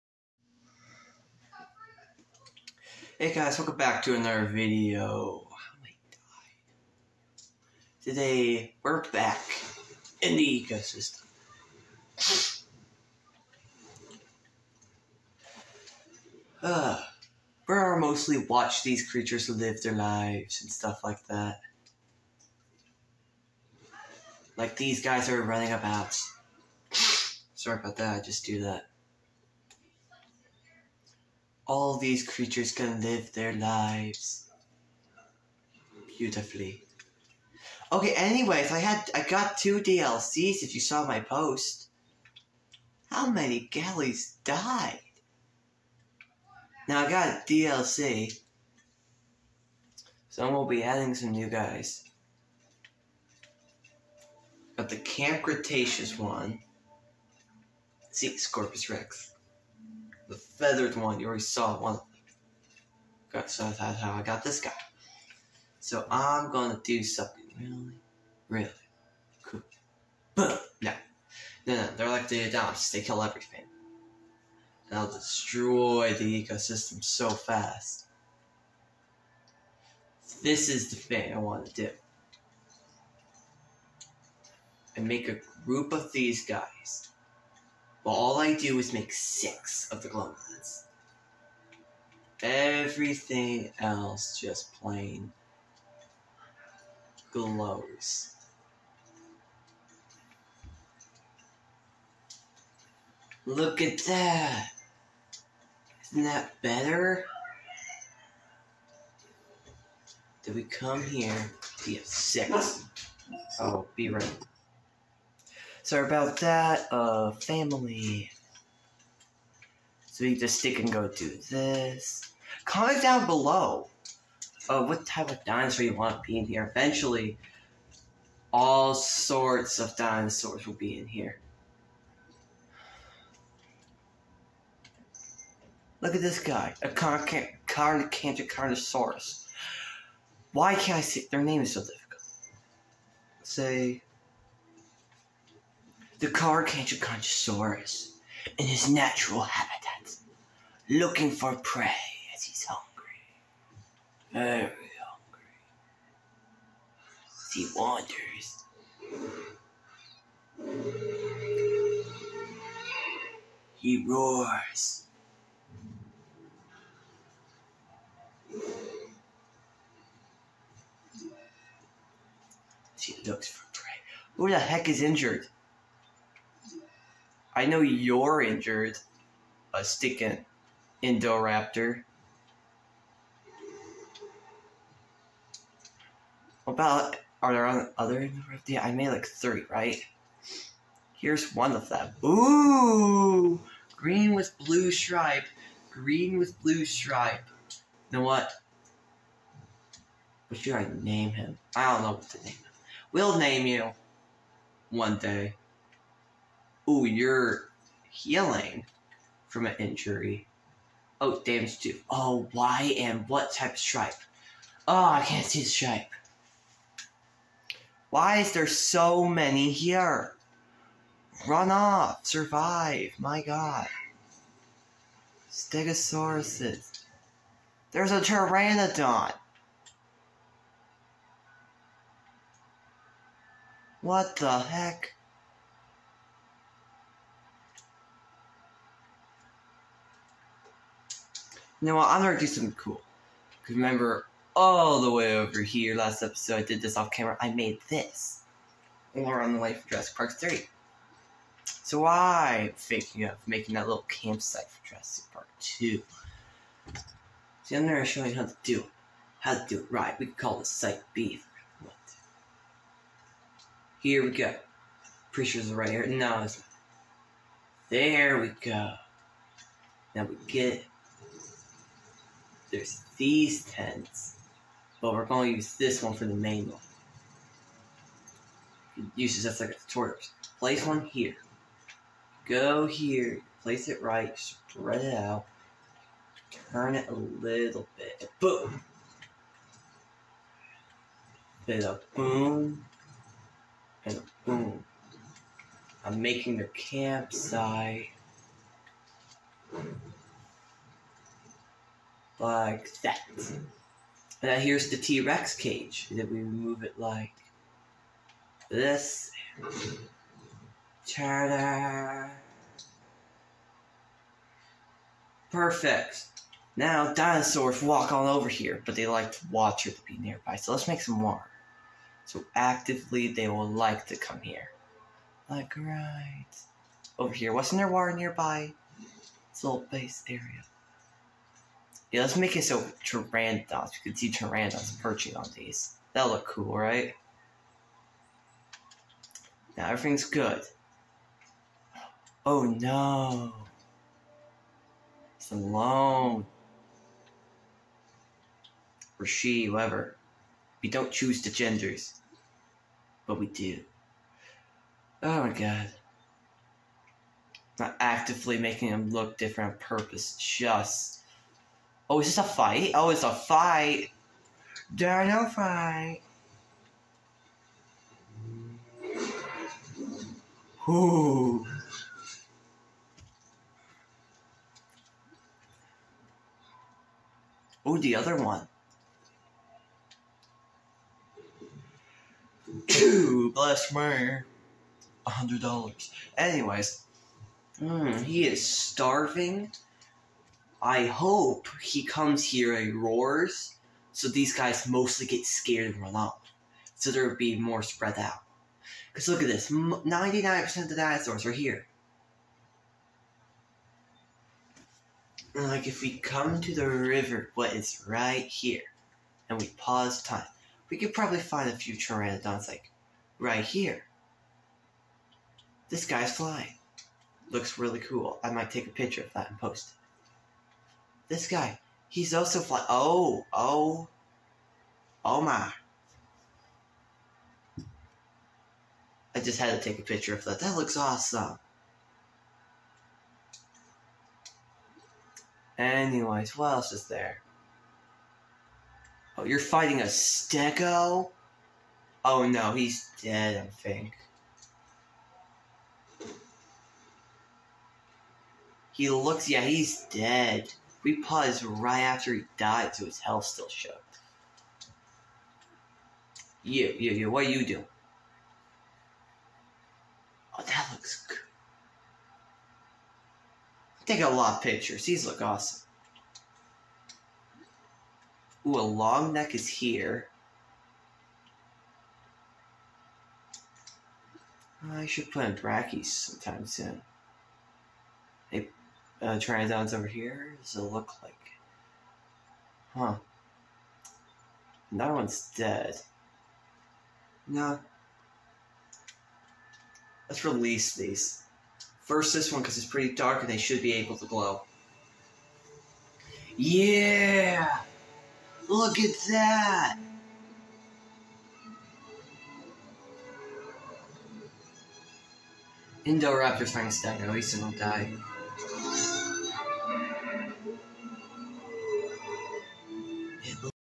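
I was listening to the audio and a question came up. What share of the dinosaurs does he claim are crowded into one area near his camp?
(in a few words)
99%.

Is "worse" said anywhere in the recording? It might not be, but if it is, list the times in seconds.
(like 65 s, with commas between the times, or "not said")
not said.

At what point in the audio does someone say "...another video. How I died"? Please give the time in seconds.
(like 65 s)
4 s.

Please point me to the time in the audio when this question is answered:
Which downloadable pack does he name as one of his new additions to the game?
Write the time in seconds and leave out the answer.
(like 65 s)
54 s.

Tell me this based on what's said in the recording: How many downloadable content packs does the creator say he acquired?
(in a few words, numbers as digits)
2.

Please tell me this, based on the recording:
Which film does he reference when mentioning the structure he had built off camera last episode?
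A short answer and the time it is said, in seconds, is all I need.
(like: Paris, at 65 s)
Jurassic Park 3, at 250 s.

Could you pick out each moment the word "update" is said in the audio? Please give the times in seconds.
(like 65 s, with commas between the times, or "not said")
not said.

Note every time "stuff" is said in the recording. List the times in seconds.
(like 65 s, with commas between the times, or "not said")
20 s.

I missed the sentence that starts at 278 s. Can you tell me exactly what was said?
It uses that's like a tutorial.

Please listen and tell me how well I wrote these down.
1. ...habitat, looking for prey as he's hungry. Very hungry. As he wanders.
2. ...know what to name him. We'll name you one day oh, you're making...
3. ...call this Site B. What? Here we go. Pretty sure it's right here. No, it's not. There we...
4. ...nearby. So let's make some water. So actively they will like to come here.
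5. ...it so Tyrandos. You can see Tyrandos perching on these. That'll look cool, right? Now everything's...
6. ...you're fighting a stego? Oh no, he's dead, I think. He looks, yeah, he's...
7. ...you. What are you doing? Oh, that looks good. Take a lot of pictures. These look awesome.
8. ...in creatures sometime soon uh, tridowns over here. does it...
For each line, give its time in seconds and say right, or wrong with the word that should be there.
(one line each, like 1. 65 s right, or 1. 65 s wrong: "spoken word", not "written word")
1. 149 s right
2. 202 s wrong: "healing", not "making"
3. 260 s right
4. 320 s right
5. 332 s right
6. 439 s right
7. 457 s right
8. 475 s wrong: "brackies", not "creatures".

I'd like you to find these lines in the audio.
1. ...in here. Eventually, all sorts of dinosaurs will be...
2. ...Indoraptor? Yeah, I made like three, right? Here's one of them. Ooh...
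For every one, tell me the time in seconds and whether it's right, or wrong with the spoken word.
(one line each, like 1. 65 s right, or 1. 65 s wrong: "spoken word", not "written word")
1. 126 s right
2. 188 s right.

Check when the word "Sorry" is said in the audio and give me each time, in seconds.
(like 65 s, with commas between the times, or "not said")
27 s, 115 s.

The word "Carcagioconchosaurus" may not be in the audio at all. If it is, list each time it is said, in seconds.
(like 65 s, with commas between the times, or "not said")
146 s.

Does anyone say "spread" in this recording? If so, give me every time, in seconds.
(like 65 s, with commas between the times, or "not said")
284 s, 397 s.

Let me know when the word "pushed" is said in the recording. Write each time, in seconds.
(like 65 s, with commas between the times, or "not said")
not said.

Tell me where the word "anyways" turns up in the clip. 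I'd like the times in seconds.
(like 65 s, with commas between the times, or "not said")
38 s, 386 s, 435 s.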